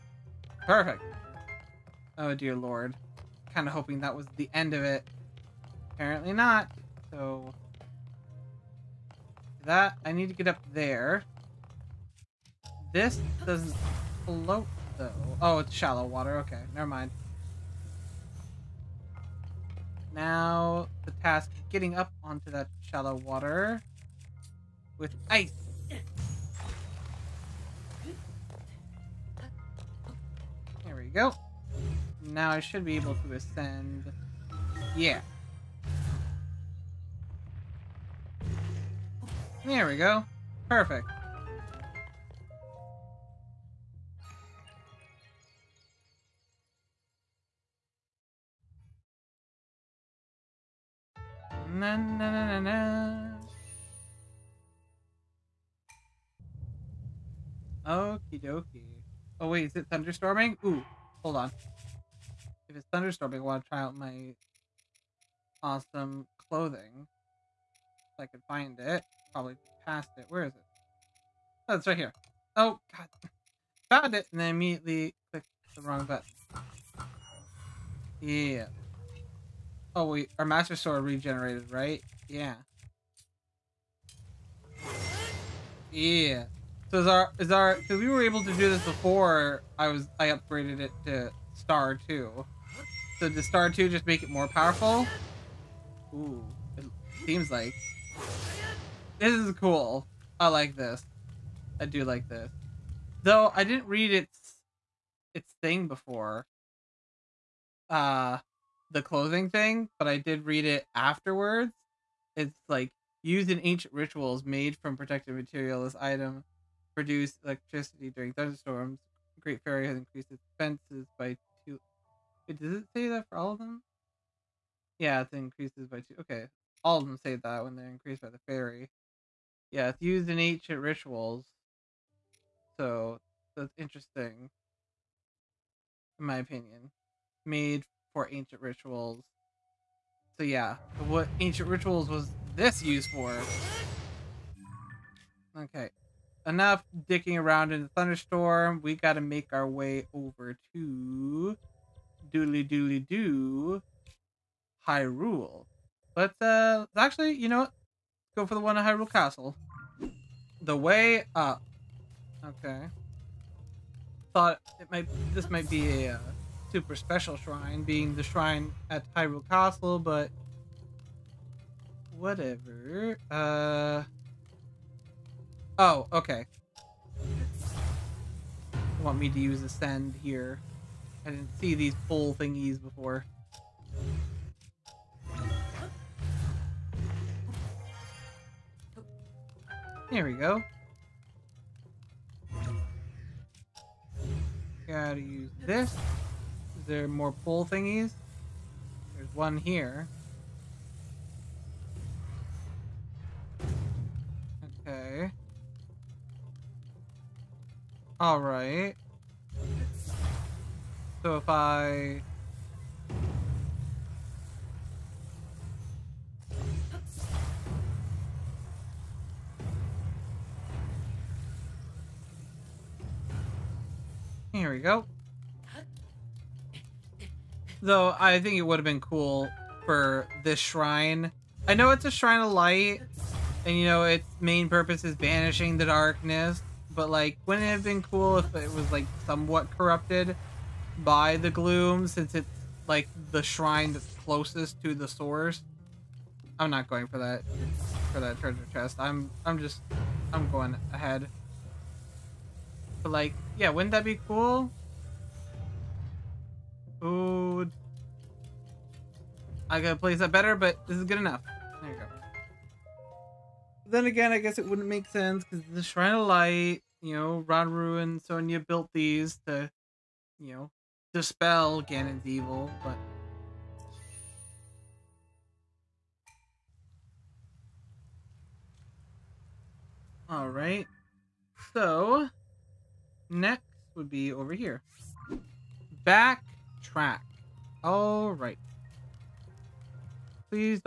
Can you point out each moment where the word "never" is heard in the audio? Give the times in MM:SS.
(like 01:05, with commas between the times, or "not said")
00:16.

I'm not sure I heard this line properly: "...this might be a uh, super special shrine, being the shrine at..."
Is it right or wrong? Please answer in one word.
right.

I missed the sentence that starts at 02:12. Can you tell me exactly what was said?
So that's interesting, in my opinion.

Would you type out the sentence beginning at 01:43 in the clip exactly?
Though I didn't read its its thing before.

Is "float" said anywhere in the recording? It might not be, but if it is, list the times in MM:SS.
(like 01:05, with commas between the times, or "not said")
00:14.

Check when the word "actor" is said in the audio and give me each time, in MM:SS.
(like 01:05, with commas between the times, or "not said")
not said.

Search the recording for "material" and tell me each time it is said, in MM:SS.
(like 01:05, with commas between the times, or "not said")
01:55.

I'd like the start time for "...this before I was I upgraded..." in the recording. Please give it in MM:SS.
01:28.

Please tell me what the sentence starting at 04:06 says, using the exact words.
I'm not going for that for that treasure chest.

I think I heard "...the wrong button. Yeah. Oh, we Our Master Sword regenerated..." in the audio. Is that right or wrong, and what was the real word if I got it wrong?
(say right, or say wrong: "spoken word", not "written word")
right.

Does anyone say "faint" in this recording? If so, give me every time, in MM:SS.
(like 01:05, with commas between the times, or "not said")
not said.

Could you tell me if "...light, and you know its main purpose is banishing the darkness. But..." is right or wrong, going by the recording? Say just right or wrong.
right.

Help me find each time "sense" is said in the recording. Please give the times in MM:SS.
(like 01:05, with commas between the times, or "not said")
04:25.